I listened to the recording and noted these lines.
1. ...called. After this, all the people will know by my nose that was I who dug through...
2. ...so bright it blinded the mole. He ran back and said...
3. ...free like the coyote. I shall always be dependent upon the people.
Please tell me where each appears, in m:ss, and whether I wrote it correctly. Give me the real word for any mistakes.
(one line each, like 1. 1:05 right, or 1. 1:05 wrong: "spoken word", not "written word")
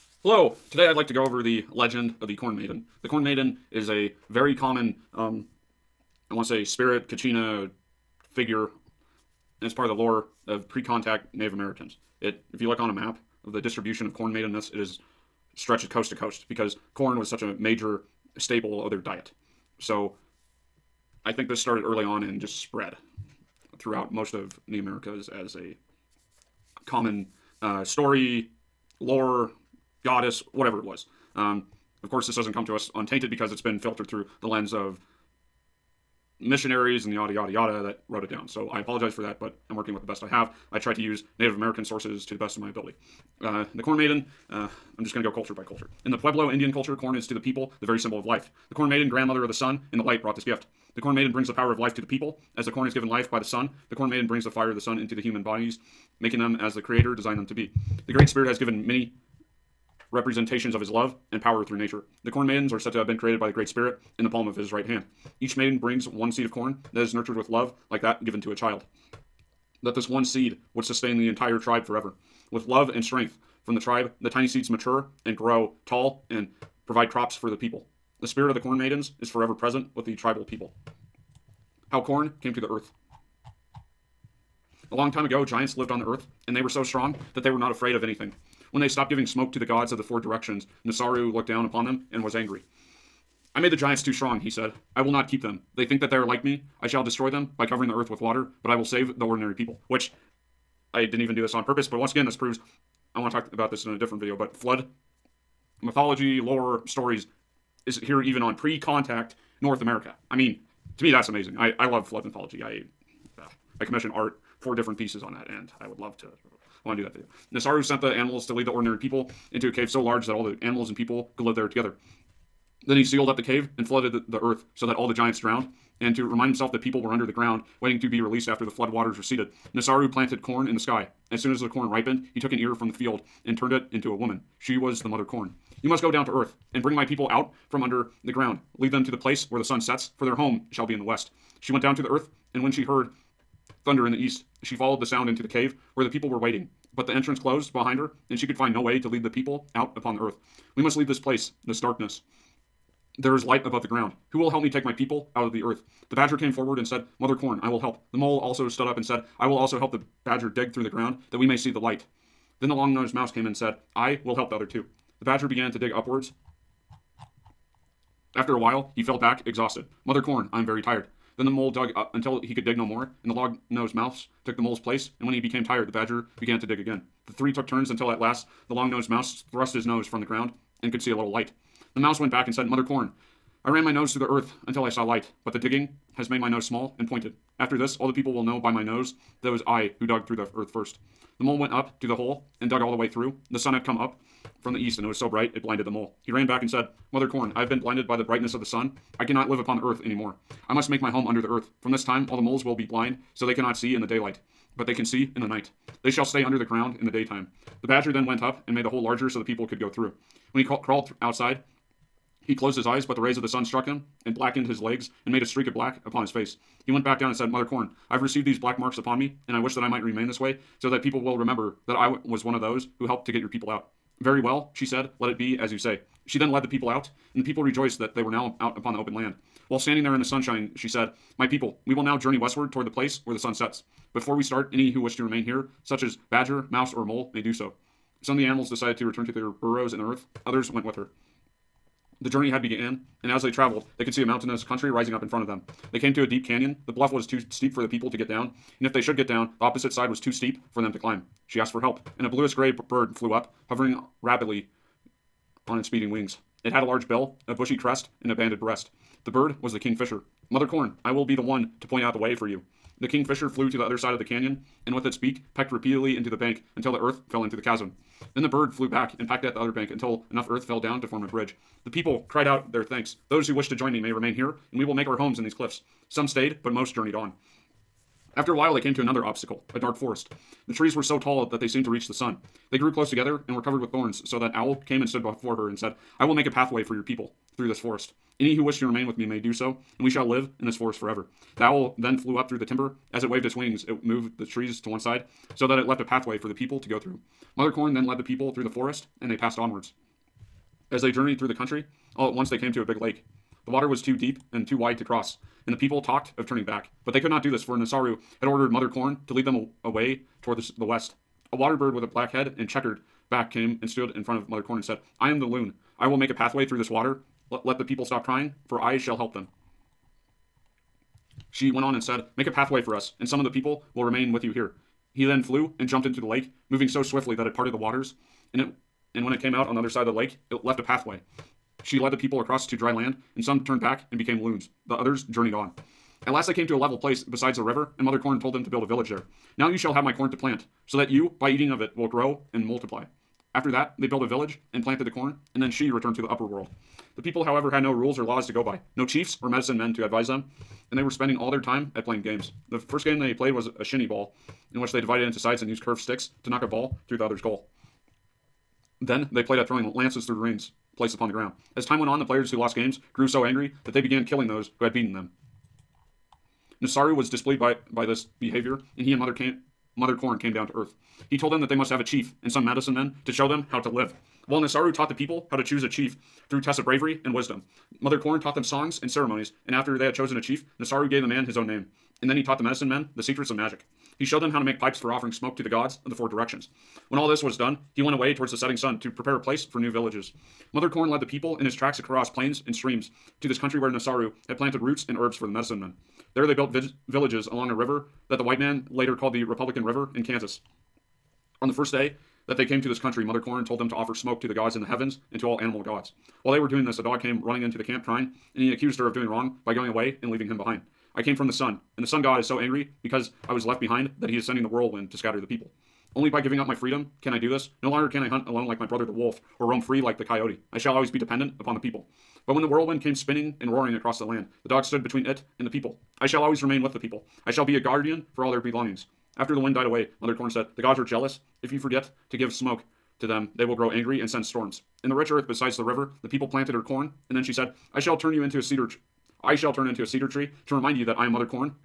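1. 3:07 wrong: "pointed", not "called"
2. 3:15 right
3. 6:59 right.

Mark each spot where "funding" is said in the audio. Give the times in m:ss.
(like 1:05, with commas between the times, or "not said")
not said.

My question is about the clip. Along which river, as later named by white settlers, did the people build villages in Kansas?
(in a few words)
Republican River.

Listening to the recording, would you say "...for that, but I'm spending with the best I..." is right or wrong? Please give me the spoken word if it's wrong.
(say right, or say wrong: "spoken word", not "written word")
wrong: "working", not "spending".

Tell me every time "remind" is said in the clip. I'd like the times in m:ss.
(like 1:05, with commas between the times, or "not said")
2:06, 7:20.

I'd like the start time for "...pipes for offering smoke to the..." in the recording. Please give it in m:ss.
6:24.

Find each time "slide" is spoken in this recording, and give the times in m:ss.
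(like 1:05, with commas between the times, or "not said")
not said.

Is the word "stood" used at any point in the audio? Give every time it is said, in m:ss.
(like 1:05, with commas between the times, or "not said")
2:38, 4:45, 5:13, 7:04.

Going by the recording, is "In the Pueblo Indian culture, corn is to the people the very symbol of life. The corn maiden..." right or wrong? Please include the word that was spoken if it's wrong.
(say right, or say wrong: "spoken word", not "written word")
right.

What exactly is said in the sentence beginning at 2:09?
Nasaru planted corn in the sky.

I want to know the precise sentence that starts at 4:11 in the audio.
She asked for help, and a bluish gray bird flew up, hovering rapidly on its speeding wings.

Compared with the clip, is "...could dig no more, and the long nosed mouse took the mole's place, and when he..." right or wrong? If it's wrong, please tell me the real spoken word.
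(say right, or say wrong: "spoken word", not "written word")
right.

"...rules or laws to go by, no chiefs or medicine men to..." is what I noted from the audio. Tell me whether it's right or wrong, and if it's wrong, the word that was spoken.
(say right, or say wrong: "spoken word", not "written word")
right.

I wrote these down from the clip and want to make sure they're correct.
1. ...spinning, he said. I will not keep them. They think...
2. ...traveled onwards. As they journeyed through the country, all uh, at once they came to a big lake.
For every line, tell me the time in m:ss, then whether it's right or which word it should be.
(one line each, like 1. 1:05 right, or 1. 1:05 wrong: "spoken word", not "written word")
1. 1:34 wrong: "strong", not "spinning"
2. 4:59 wrong: "passed", not "traveled".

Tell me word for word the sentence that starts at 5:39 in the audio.
Now you shall have my corn to plant, so that you, by eating of it, will grow and multiply.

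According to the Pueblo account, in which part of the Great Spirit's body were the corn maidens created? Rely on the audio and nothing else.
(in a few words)
Palm of his right hand.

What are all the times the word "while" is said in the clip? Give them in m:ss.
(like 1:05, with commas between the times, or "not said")
2:48, 3:49, 4:38, 6:14, 6:46.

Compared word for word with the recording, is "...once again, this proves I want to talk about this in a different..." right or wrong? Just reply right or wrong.
right.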